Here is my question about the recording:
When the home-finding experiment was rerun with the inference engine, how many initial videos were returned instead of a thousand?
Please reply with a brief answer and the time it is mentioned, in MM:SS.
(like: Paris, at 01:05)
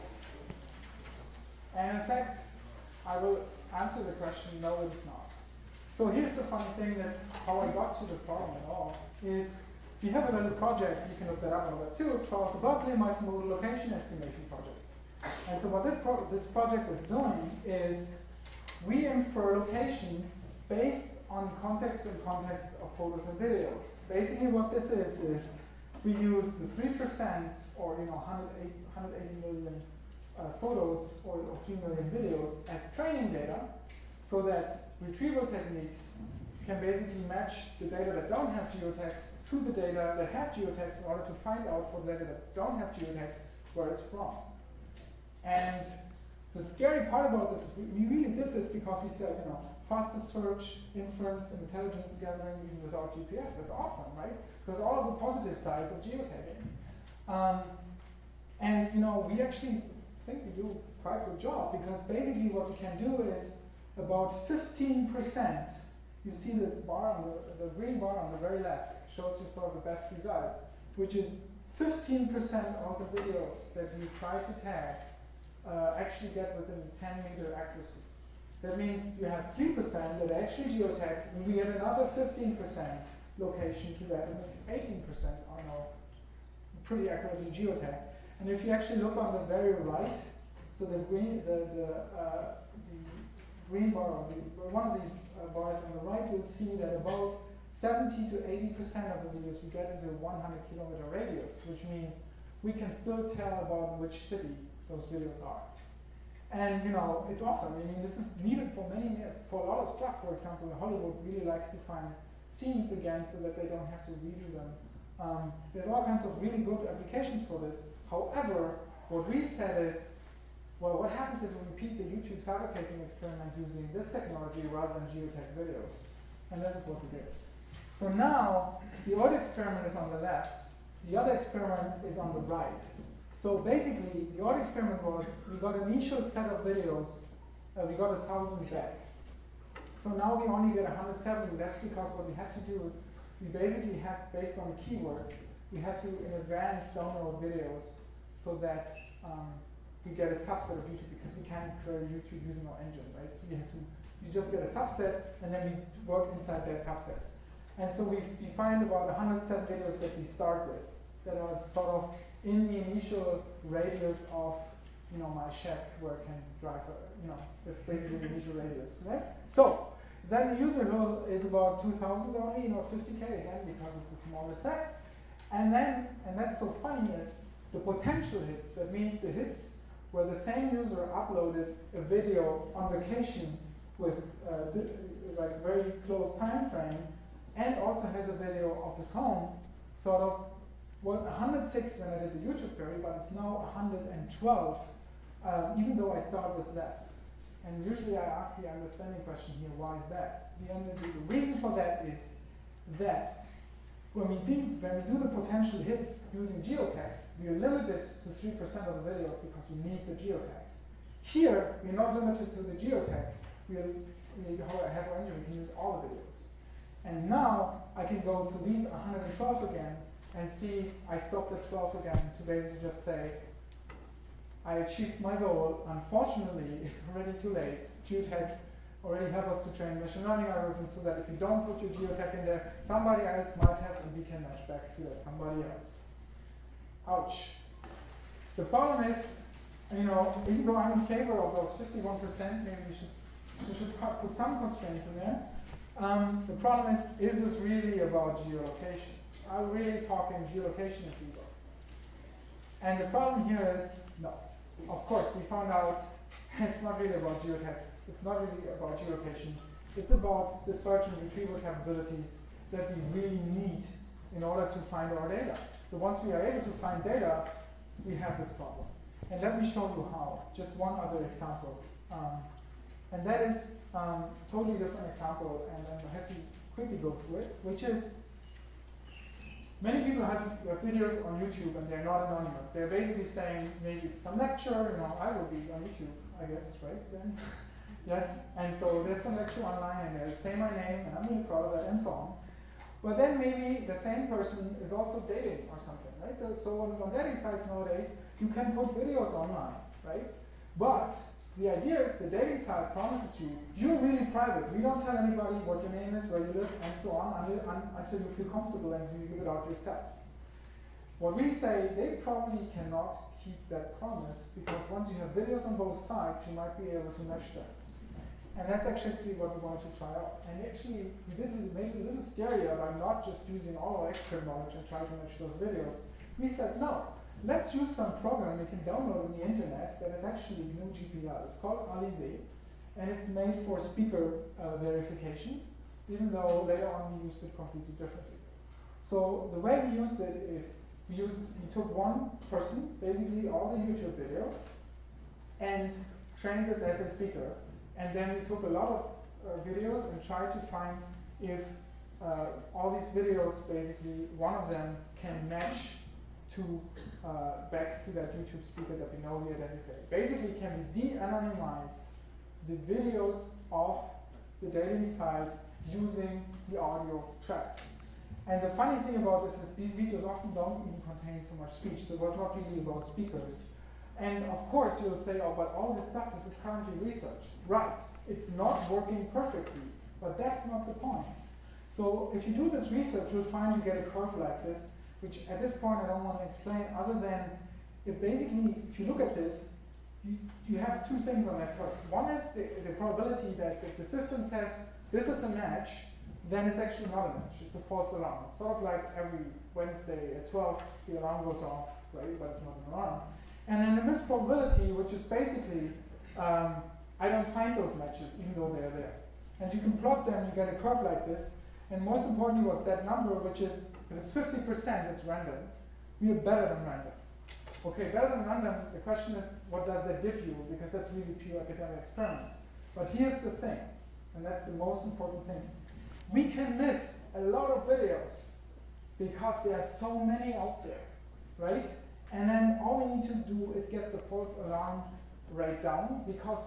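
170, at 02:20.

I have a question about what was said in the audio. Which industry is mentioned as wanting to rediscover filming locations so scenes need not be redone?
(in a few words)
Hollywood.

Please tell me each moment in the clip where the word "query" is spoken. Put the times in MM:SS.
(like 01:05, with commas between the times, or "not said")
02:31, 03:12.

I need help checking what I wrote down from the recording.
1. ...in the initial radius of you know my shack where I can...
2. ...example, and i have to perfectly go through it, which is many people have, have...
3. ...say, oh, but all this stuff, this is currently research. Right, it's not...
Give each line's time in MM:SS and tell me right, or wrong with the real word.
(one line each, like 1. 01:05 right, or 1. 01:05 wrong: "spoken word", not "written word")
1. 02:42 right
2. 04:35 wrong: "quickly", not "perfectly"
3. 06:15 right.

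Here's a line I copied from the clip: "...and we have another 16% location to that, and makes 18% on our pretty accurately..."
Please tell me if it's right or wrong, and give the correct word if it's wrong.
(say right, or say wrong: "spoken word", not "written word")
wrong: "15", not "16".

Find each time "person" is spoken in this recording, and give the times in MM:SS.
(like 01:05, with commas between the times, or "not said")
04:54, 05:42.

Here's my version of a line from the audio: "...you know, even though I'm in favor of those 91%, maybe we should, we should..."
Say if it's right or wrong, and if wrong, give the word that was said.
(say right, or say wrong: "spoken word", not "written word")
wrong: "51", not "91".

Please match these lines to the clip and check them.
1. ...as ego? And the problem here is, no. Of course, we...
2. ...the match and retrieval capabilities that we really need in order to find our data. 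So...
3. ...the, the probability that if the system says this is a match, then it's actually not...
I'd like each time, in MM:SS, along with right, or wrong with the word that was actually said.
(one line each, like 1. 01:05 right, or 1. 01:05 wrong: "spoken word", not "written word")
1. 04:11 right
2. 04:20 wrong: "search", not "match"
3. 06:32 right.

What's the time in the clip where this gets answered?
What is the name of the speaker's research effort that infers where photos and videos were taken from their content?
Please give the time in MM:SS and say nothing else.
00:12.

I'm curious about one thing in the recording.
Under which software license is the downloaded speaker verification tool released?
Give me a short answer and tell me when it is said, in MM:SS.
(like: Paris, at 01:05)
GNU GPL, at 05:30.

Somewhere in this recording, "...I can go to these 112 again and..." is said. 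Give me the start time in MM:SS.
03:37.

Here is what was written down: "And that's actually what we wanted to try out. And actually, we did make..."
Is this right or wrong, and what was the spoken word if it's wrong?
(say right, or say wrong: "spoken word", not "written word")
right.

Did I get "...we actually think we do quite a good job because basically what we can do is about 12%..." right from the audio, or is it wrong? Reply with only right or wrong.
wrong.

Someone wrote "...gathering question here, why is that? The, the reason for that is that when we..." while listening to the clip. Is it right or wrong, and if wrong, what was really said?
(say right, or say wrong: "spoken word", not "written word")
wrong: "understanding", not "gathering".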